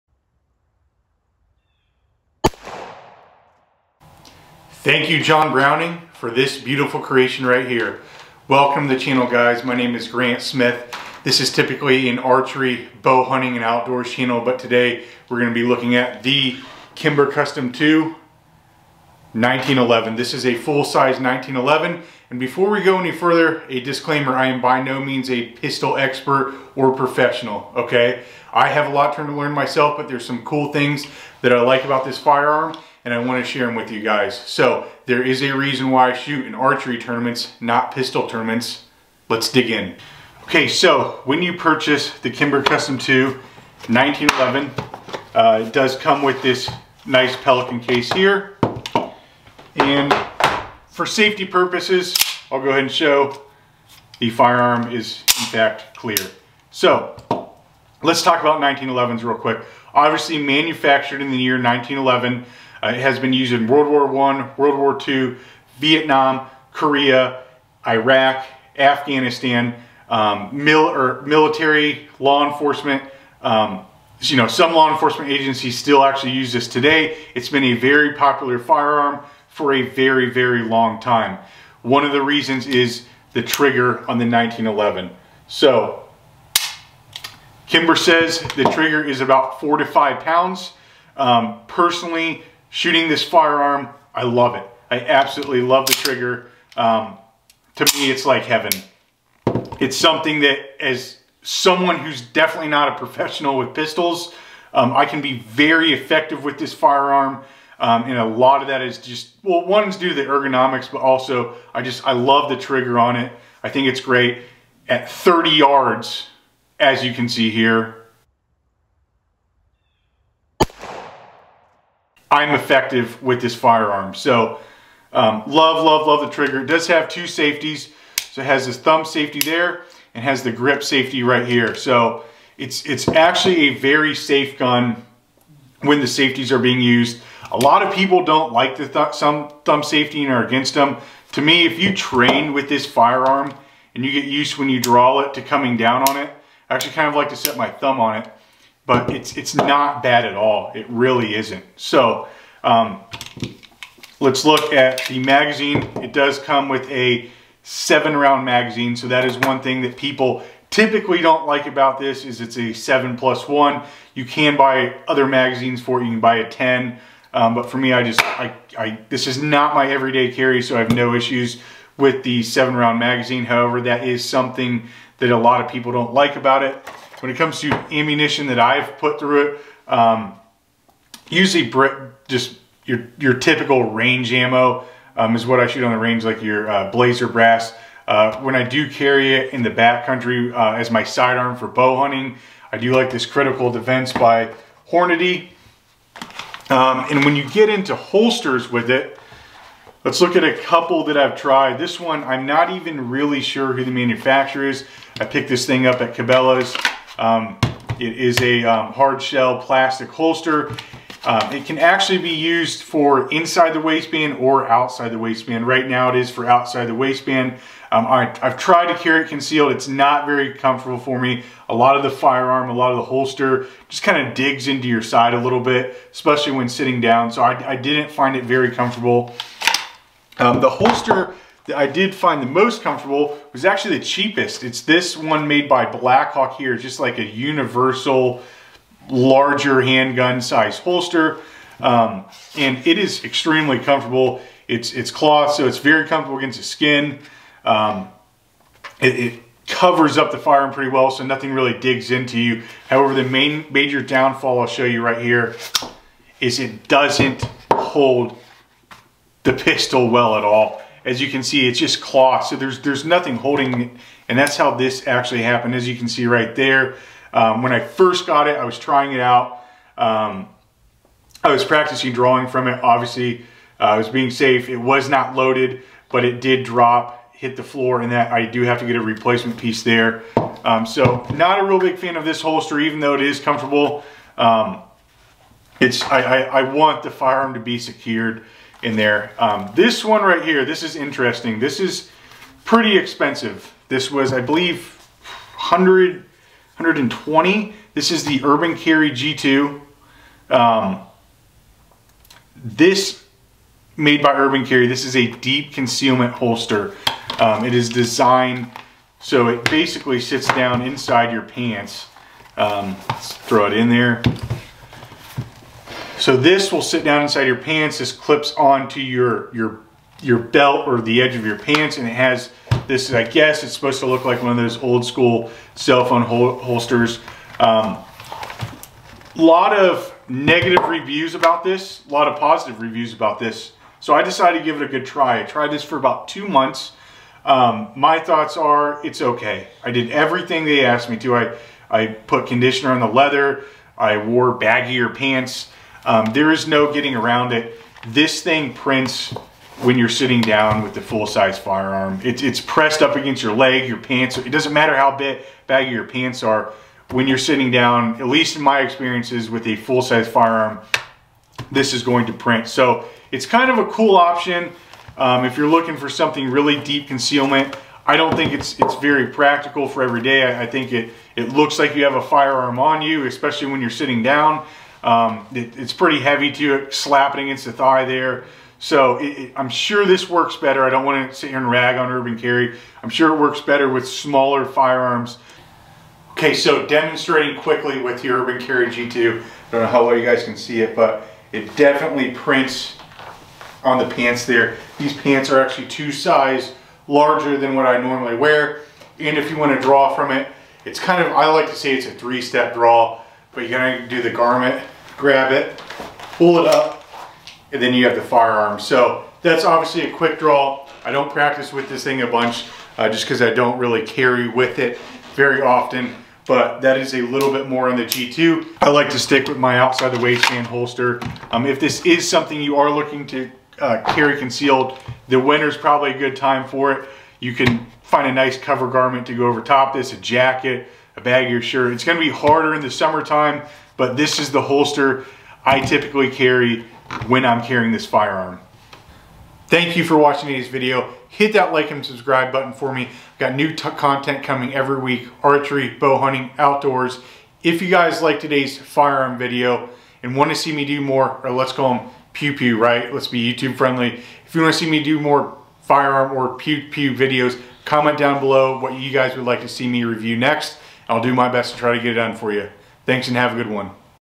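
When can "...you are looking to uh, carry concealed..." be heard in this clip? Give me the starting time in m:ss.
7:02.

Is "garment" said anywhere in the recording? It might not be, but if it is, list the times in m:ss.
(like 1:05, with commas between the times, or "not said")
6:44, 7:08.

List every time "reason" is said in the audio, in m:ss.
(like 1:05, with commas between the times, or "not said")
0:35, 1:22.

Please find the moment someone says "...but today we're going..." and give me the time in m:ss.
0:14.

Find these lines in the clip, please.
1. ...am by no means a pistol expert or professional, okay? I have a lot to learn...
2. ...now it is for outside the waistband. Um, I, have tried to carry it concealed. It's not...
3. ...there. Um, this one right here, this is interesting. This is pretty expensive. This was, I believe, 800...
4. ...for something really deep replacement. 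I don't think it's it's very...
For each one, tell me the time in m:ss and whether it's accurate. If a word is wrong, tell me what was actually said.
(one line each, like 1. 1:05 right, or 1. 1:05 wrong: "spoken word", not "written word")
1. 0:24 right
2. 3:35 right
3. 4:48 wrong: "100", not "800"
4. 6:05 wrong: "concealment", not "replacement".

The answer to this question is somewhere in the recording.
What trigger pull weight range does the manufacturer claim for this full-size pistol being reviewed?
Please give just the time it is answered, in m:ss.
1:29.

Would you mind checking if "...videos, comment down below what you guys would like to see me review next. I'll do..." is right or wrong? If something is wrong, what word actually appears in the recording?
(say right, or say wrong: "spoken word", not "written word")
right.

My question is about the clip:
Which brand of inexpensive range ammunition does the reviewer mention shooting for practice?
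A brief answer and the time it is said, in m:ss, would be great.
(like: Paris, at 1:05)
Blazer Brass, at 3:06.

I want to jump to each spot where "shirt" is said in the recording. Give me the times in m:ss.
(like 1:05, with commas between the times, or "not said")
7:11.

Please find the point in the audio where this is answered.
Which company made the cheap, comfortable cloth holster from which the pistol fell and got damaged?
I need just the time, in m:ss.
3:55.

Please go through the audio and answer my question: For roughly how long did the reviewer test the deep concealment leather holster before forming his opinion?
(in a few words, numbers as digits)
2 months.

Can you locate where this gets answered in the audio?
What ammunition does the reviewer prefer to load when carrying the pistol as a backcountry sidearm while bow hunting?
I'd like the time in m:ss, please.
3:13.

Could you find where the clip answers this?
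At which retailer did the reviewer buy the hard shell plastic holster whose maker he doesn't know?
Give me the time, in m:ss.
3:26.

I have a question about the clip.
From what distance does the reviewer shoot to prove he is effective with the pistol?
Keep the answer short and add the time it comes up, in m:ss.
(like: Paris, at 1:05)
30 yards, at 1:55.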